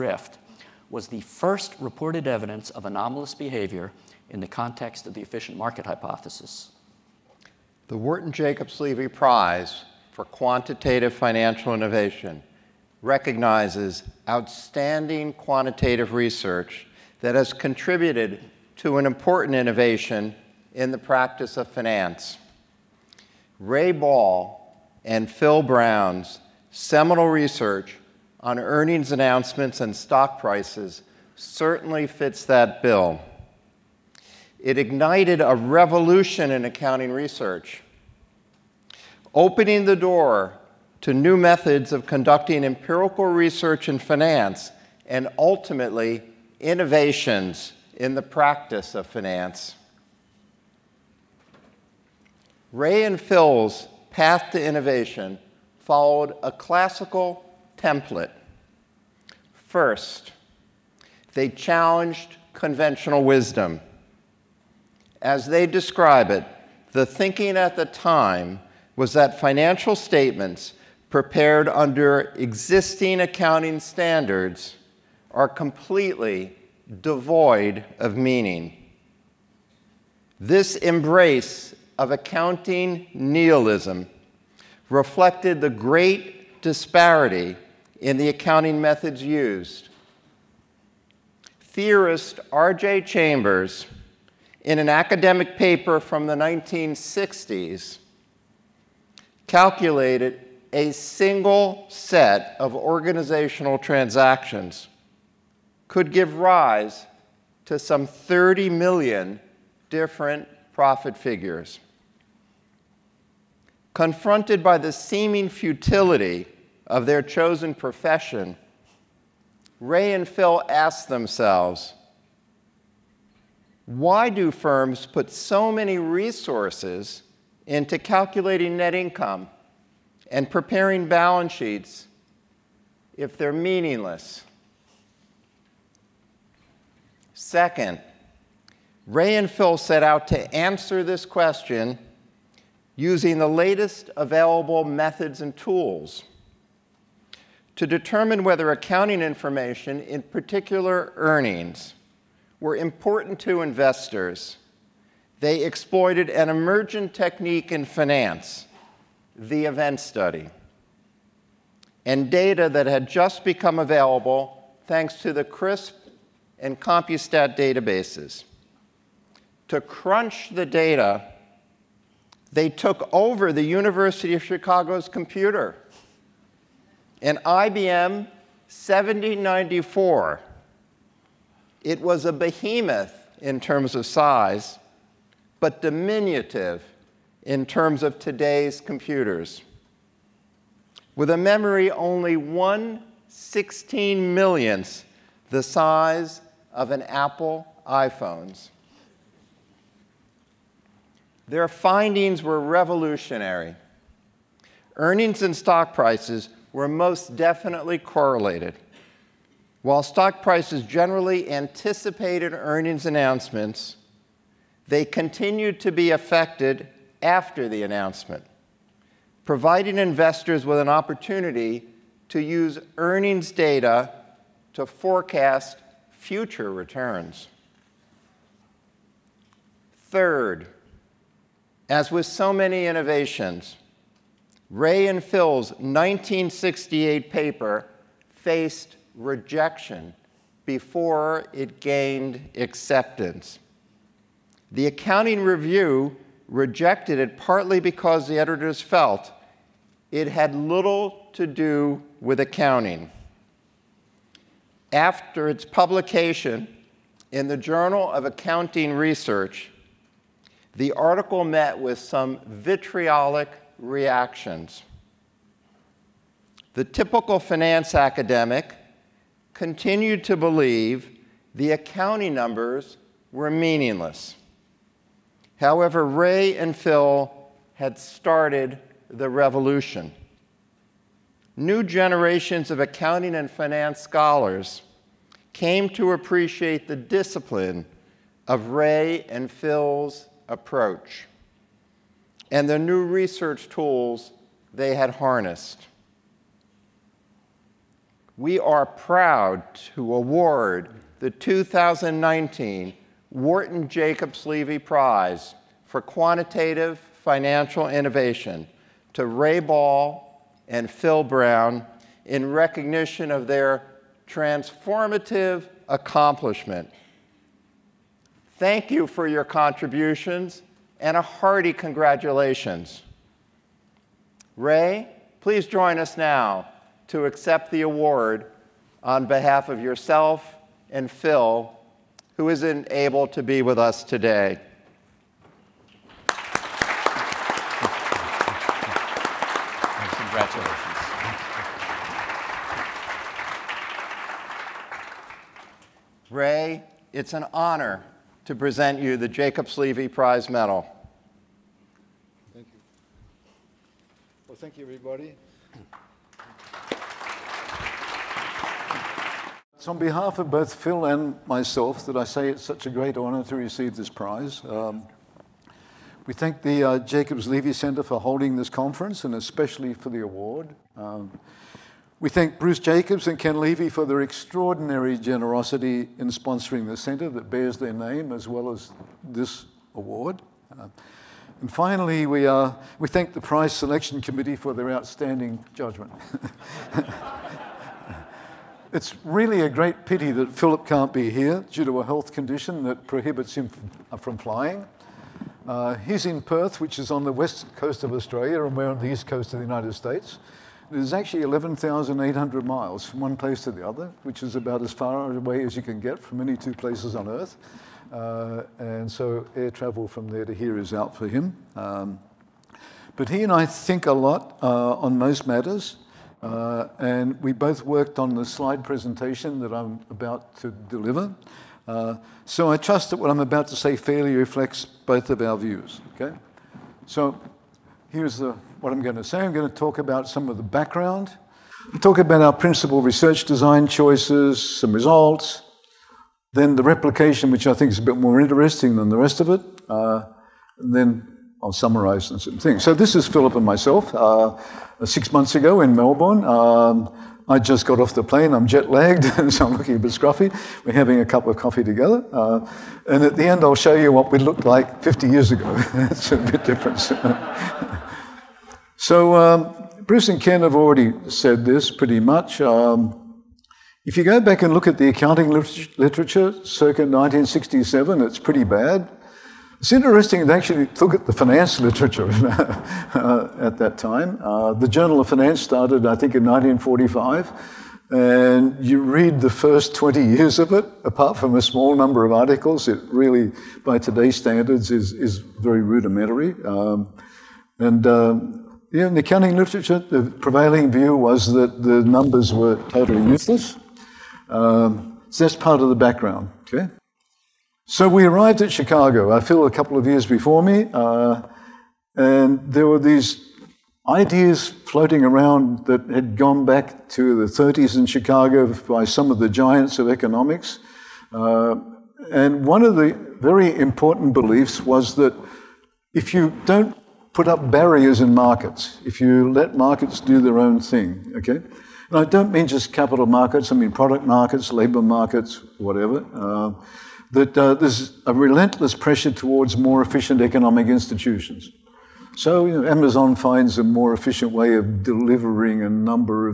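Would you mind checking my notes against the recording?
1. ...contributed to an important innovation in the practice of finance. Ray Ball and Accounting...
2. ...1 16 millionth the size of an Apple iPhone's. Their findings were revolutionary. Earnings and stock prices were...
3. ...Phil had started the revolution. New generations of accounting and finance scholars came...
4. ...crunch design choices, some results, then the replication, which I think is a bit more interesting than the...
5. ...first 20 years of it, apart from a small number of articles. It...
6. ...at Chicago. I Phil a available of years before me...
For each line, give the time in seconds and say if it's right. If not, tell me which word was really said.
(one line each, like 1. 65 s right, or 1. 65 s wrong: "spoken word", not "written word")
1. 17 s wrong: "Phil", not "Accounting"
2. 192 s right
3. 276 s right
4. 432 s wrong: "research", not "crunch"
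5. 479 s right
6. 498 s wrong: "couple", not "available".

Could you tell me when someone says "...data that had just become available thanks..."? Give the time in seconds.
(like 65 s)
162 s.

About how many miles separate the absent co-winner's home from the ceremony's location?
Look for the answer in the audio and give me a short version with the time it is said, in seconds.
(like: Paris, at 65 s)
11,800, at 401 s.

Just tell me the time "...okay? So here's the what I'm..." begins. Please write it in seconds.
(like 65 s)
426 s.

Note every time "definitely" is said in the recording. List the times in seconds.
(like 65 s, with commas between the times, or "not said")
207 s.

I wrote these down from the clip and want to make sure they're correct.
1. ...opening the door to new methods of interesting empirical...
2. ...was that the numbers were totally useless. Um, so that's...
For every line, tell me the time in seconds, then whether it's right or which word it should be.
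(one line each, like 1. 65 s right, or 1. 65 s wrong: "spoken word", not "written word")
1. 39 s wrong: "conducting", not "interesting"
2. 491 s right.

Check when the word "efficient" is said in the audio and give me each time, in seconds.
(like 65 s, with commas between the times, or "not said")
5 s, 530 s, 534 s.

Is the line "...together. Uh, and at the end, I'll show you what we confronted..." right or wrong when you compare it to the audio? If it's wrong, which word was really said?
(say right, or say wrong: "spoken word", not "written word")
wrong: "looked", not "confronted".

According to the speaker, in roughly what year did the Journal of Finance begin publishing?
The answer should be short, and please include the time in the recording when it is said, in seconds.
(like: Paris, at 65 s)
1945, at 476 s.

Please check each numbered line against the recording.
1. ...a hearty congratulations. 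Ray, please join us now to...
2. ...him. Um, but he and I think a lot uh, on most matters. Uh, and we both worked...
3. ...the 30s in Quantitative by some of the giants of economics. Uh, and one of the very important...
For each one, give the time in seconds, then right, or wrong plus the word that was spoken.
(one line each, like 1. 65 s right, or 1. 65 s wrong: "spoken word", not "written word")
1. 321 s right
2. 411 s right
3. 507 s wrong: "Chicago", not "Quantitative".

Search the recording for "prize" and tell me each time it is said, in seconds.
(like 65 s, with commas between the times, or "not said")
9 s, 304 s, 350 s, 364 s, 383 s.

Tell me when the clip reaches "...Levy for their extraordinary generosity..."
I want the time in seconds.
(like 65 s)
373 s.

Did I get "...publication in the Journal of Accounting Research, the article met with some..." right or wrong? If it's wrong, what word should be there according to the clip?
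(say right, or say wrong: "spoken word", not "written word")
right.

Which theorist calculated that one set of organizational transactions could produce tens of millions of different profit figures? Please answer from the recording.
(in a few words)
R.J. Chambers.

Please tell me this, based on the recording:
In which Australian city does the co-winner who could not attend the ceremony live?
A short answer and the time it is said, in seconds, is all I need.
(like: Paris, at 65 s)
Perth, at 396 s.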